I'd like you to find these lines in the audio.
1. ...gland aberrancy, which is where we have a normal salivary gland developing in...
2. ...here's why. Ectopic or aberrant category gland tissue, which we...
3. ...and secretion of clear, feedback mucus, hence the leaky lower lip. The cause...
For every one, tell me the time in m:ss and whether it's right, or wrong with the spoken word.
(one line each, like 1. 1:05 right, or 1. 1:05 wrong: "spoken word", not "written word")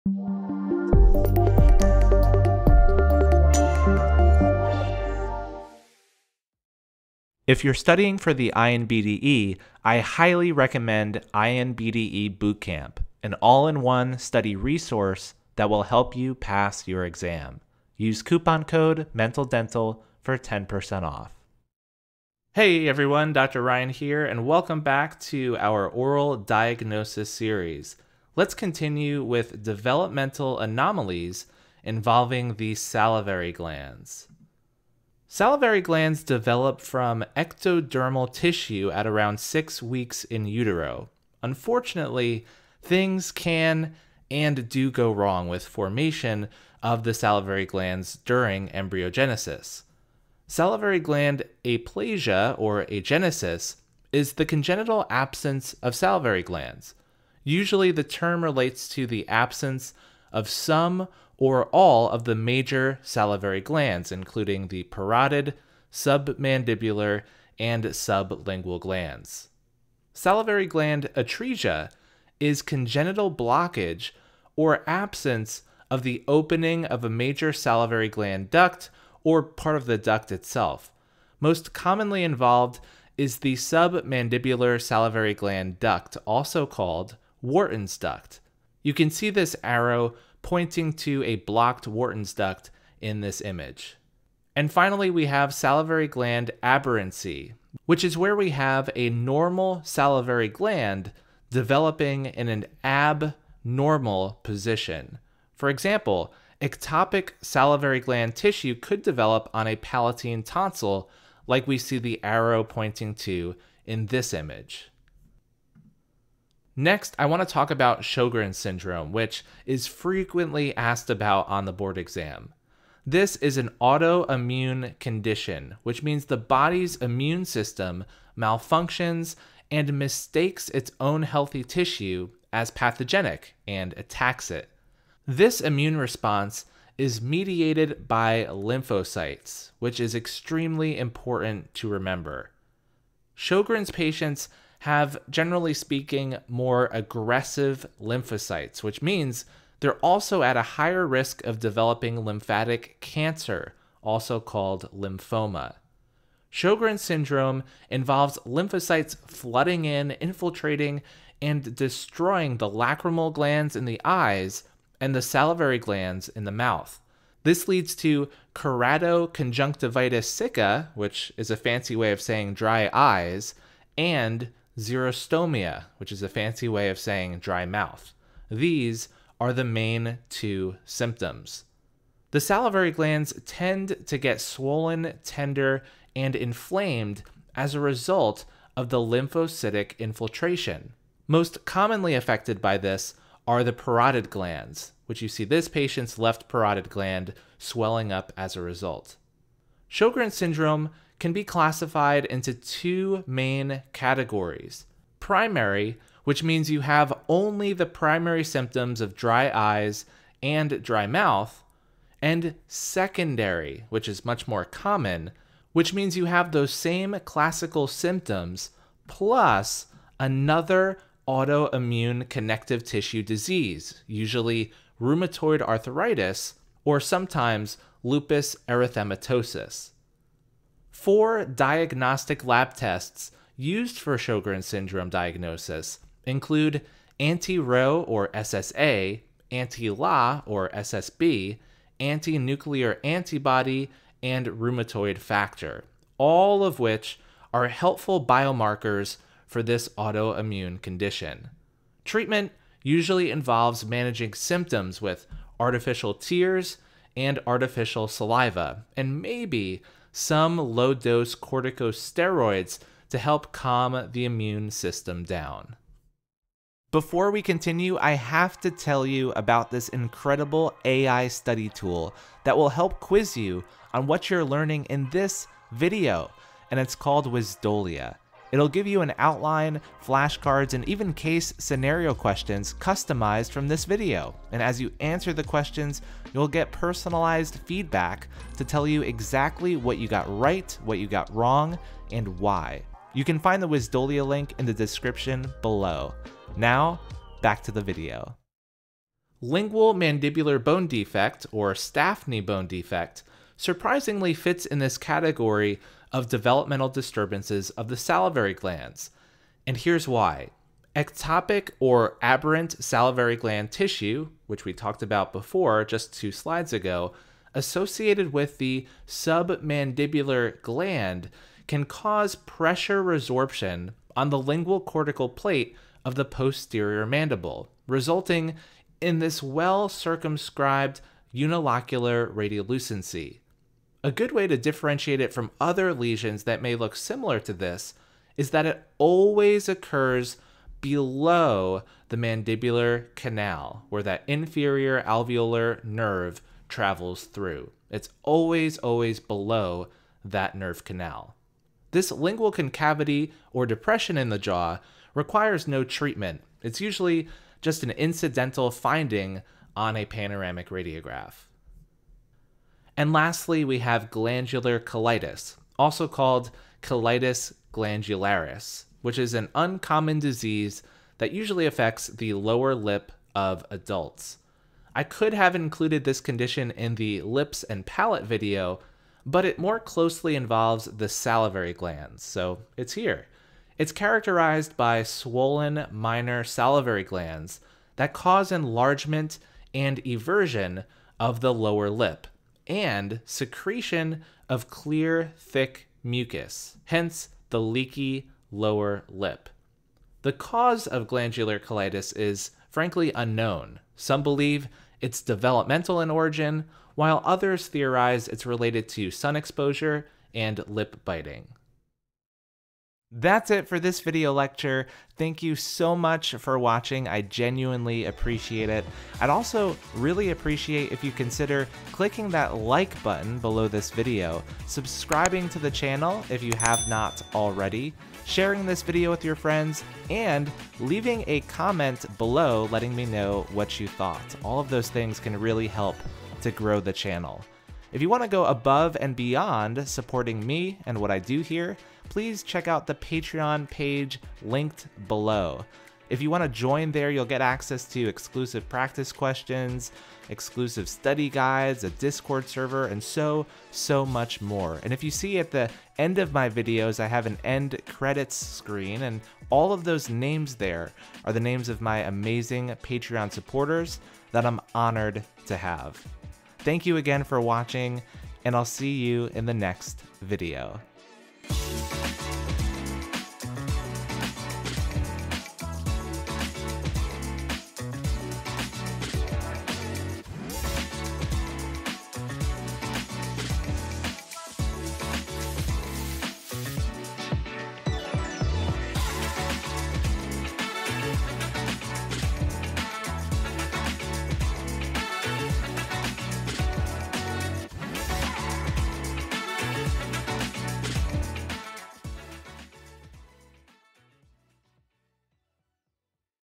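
1. 1:36 right
2. 5:09 wrong: "salivary", not "category"
3. 6:32 wrong: "thick", not "feedback".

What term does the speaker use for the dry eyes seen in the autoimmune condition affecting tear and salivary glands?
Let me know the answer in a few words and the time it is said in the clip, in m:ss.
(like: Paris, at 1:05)
keratoconjunctivitis sicca, at 2:48.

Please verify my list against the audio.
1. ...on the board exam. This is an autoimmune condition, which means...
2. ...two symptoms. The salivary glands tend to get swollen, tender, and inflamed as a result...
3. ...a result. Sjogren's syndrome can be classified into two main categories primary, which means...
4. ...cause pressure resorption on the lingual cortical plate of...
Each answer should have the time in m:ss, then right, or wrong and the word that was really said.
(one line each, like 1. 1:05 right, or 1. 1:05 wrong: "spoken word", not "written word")
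1. 2:01 right
2. 3:00 right
3. 3:18 right
4. 5:21 right.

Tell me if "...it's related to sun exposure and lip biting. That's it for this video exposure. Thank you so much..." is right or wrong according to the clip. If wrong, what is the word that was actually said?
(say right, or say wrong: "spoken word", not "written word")
wrong: "lecture", not "exposure".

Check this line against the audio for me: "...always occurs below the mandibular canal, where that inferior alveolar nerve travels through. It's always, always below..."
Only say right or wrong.
right.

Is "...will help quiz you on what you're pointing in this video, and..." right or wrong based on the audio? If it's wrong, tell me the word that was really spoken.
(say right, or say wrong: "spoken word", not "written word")
wrong: "learning", not "pointing".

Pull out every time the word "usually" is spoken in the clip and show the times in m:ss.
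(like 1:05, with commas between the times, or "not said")
0:57, 3:44, 4:12, 5:56, 6:11.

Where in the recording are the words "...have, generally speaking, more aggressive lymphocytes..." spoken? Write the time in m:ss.
2:24.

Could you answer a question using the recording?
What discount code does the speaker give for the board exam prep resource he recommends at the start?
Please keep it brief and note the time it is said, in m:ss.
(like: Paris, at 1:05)
MENTALDENTAL, at 0:19.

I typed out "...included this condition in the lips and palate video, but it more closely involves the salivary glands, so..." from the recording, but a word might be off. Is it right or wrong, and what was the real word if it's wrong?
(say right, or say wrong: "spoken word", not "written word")
right.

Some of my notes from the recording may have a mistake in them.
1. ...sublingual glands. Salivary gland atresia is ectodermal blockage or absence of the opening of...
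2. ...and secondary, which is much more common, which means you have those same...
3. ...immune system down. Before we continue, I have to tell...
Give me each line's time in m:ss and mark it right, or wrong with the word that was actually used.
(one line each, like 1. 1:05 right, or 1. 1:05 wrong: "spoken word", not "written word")
1. 1:07 wrong: "congenital", not "ectodermal"
2. 3:32 right
3. 4:24 right.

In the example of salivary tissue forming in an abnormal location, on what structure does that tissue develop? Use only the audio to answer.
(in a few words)
palatine tonsil.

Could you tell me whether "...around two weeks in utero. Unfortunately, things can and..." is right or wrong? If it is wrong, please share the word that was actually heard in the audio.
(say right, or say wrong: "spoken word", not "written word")
wrong: "six", not "two".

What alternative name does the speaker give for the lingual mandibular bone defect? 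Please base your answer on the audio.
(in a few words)
Stafne bone defect.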